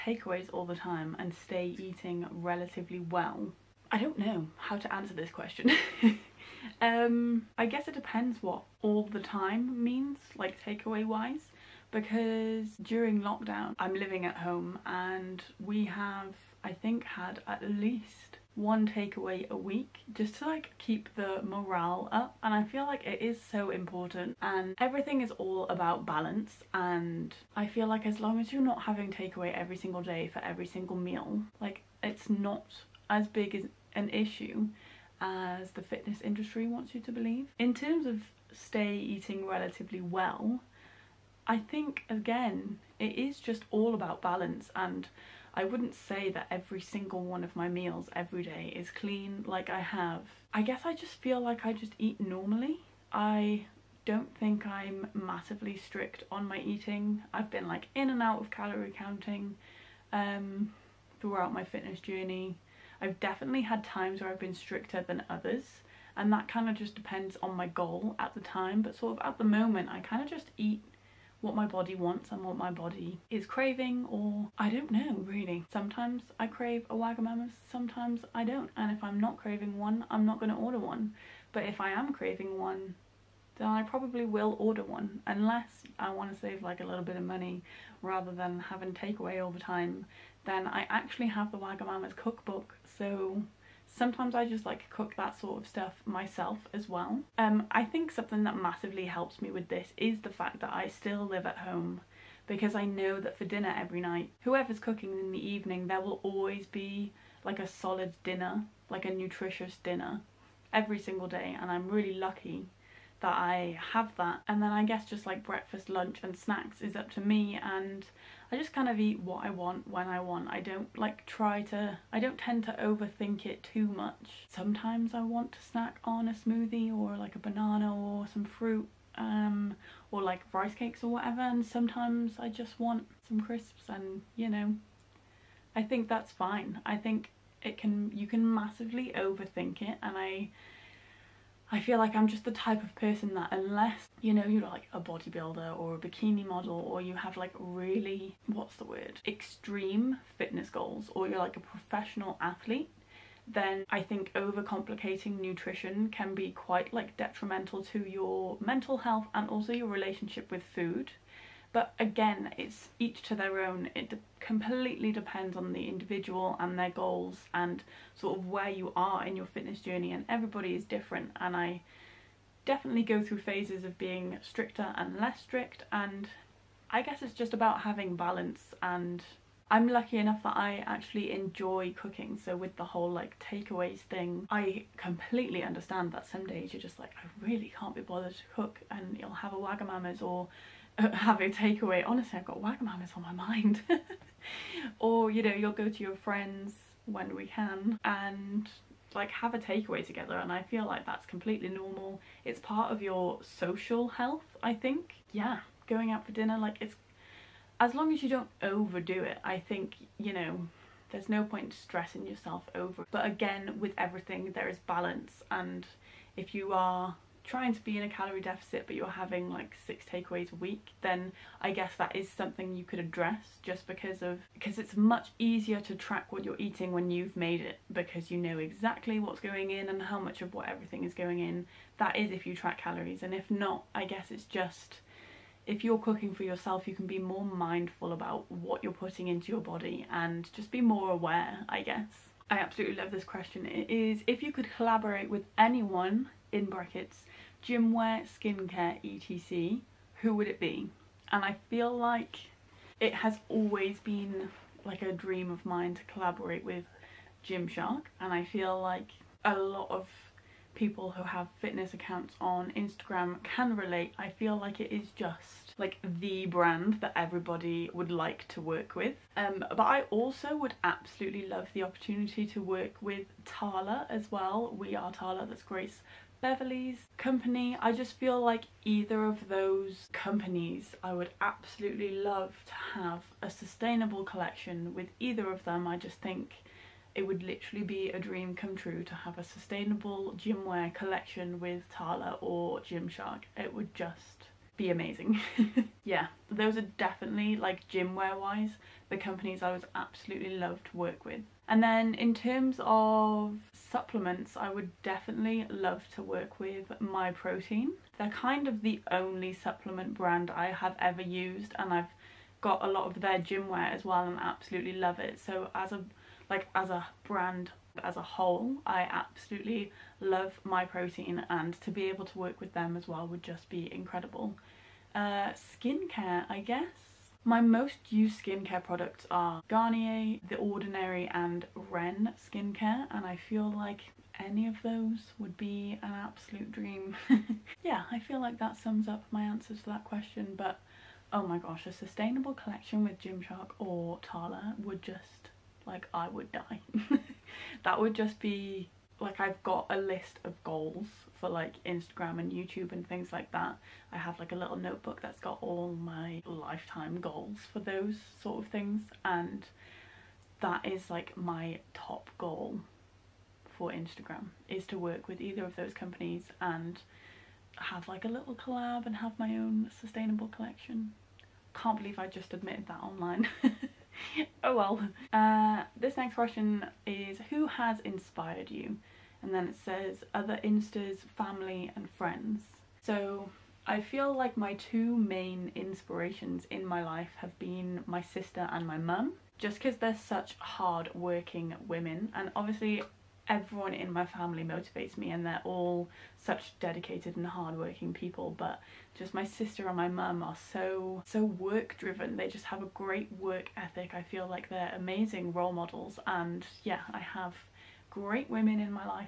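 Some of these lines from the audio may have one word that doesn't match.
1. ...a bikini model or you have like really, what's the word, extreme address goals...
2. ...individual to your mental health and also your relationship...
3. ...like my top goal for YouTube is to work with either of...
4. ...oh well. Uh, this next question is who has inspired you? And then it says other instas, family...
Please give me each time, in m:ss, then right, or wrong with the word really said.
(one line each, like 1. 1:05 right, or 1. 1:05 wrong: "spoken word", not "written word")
1. 2:25 wrong: "fitness", not "address"
2. 2:37 wrong: "detrimental", not "individual"
3. 6:01 wrong: "Instagram", not "YouTube"
4. 6:14 right.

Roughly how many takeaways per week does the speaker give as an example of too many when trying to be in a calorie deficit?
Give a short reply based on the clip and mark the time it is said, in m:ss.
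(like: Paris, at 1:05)
6, at 3:39.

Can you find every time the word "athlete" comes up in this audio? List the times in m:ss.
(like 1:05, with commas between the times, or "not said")
2:32.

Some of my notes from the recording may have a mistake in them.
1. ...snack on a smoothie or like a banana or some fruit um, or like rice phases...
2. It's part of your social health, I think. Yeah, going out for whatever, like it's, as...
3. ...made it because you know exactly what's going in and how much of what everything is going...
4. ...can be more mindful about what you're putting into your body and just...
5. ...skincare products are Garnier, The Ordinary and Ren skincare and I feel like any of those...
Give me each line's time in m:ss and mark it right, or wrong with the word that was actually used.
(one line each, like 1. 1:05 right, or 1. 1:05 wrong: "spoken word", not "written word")
1. 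2:05 wrong: "cakes", not "phases"
2. 3:22 wrong: "dinner", not "whatever"
3. 3:47 right
4. 3:56 right
5. 5:28 right.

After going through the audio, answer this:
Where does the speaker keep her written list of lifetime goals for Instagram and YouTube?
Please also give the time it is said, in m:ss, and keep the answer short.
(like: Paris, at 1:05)
a little notebook, at 5:54.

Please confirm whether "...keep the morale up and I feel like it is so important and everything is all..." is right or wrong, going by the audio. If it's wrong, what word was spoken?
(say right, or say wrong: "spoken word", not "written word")
right.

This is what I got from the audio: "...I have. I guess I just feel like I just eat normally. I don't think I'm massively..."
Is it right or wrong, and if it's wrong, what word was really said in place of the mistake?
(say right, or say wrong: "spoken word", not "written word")
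right.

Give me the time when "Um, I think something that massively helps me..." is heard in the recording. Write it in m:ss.
1:37.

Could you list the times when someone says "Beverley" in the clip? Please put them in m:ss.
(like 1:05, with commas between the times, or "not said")
4:36.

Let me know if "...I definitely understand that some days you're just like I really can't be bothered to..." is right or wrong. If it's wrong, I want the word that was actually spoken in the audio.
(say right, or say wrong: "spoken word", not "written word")
wrong: "completely", not "definitely".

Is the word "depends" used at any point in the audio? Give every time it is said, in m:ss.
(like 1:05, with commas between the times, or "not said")
0:07, 1:06, 2:45.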